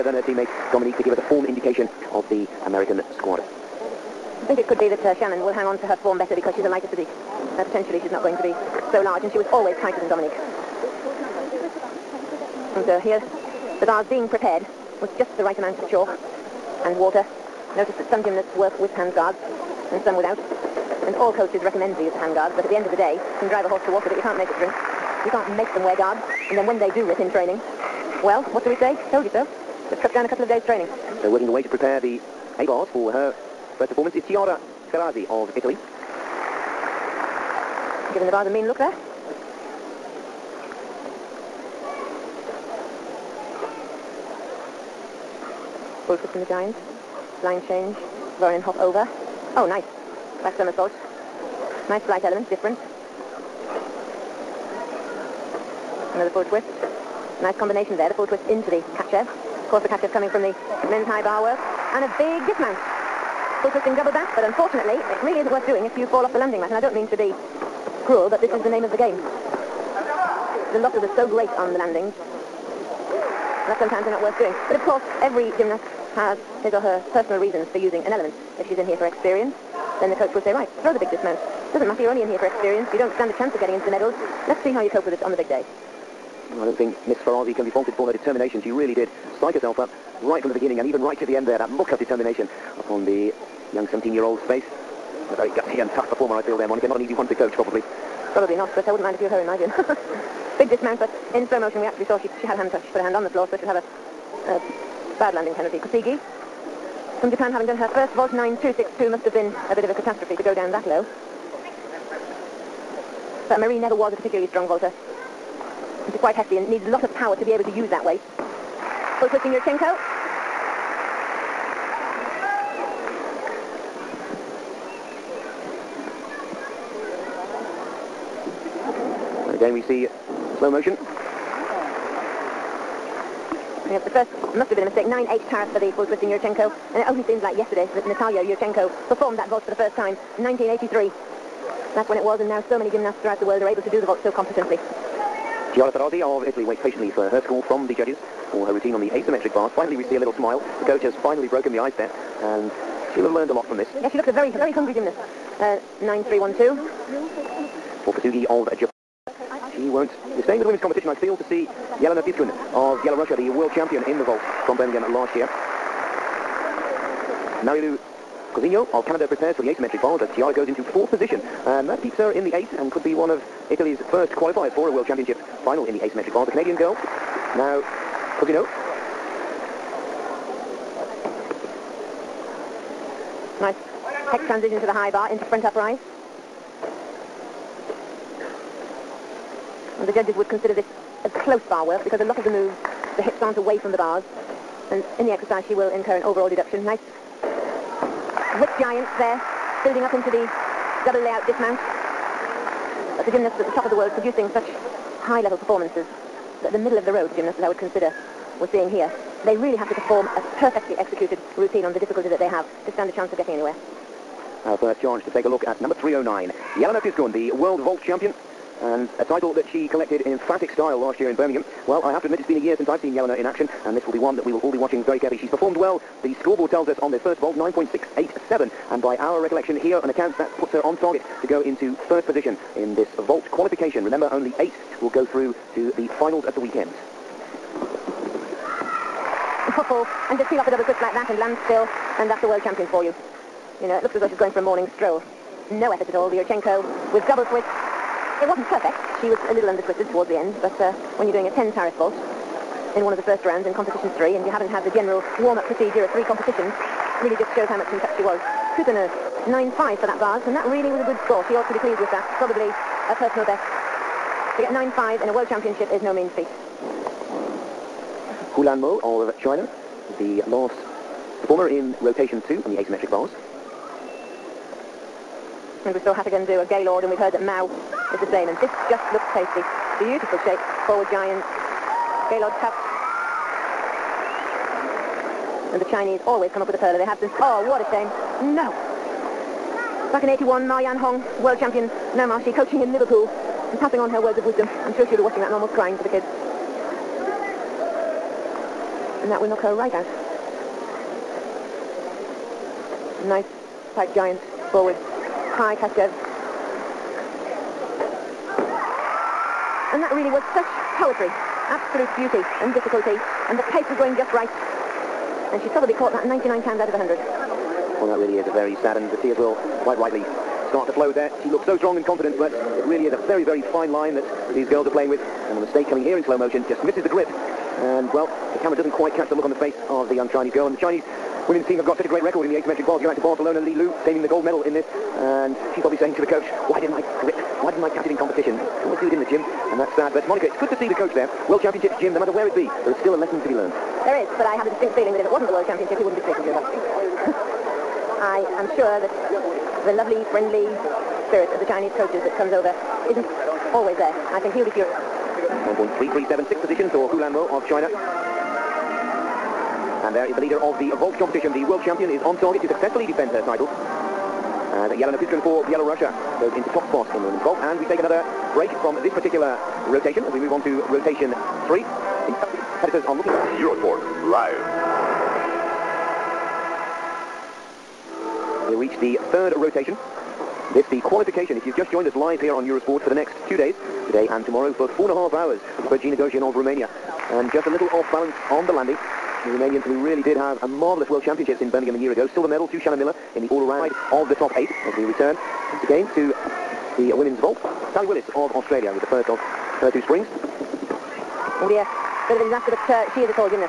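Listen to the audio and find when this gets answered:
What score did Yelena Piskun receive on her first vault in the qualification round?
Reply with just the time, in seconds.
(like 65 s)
227 s.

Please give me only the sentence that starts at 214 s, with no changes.
Our first chance to take a look at number 309.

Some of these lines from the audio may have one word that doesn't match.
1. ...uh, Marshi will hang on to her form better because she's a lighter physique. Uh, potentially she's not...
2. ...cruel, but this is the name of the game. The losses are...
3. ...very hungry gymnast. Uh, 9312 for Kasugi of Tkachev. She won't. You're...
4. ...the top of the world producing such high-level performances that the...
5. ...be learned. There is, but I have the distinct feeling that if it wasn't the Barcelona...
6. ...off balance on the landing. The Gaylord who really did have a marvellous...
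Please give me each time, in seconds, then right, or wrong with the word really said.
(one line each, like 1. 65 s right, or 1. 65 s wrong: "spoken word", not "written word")
1. 5 s wrong: "Shannon", not "Marshi"
2. 68 s right
3. 154 s wrong: "Japan", not "Tkachev"
4. 203 s right
5. 343 s wrong: "World", not "Barcelona"
6. 387 s wrong: "Romanian", not "Gaylord".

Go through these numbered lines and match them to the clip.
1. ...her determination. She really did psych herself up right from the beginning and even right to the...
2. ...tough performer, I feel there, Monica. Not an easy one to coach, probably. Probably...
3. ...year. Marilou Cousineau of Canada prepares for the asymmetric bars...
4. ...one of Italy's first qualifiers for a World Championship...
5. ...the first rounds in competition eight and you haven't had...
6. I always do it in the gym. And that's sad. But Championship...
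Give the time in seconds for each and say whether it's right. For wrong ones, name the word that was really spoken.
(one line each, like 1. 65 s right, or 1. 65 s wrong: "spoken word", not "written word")
1. 88 s right
2. 95 s right
3. 165 s right
4. 173 s right
5. 253 s wrong: "three", not "eight"
6. 338 s wrong: "Monica", not "Championship".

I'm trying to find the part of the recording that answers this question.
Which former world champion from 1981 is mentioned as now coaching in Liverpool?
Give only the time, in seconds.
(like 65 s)
290 s.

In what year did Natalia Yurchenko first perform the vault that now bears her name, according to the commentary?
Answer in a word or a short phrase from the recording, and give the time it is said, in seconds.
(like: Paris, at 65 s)
1983, at 140 s.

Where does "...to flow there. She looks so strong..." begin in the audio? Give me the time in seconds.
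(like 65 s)
320 s.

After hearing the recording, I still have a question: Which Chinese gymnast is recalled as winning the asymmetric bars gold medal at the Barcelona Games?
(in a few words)
Li Lu.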